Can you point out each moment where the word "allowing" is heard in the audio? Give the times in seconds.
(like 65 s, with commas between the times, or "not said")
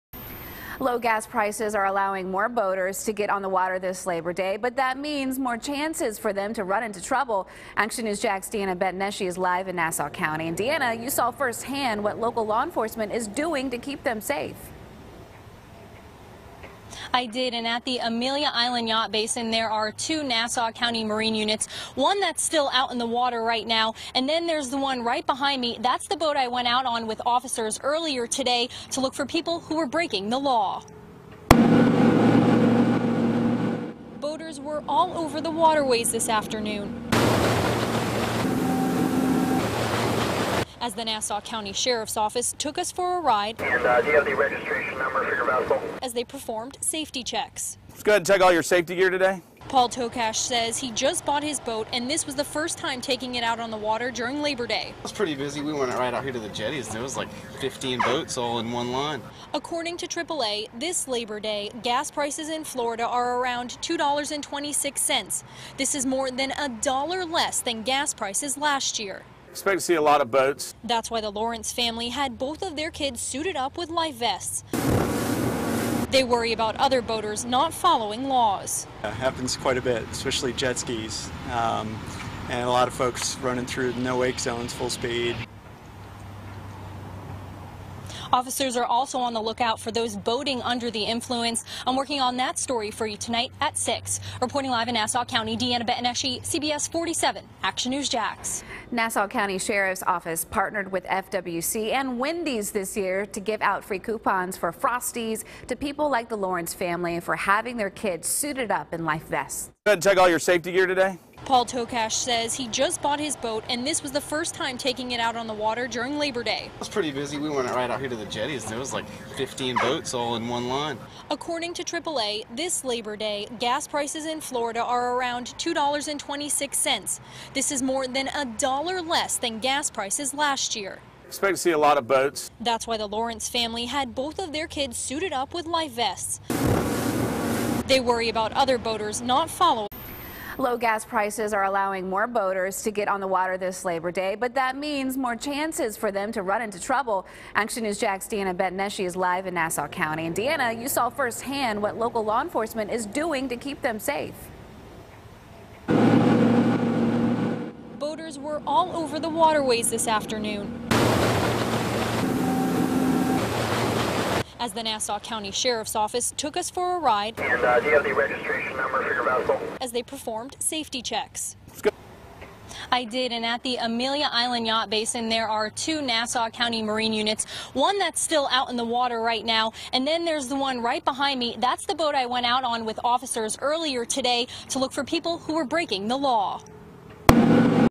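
1 s, 141 s.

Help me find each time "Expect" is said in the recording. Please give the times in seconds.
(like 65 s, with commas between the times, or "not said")
69 s, 131 s.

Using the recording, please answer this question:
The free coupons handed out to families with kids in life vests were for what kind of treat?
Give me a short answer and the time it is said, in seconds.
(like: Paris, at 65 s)
Frosties, at 104 s.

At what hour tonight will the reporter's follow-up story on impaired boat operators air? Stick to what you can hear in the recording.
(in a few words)
6.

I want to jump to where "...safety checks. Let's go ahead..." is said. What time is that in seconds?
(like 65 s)
46 s.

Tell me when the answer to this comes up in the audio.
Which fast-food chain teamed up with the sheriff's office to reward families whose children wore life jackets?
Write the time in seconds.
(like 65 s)
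102 s.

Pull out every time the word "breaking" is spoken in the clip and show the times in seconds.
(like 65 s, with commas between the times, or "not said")
29 s, 185 s.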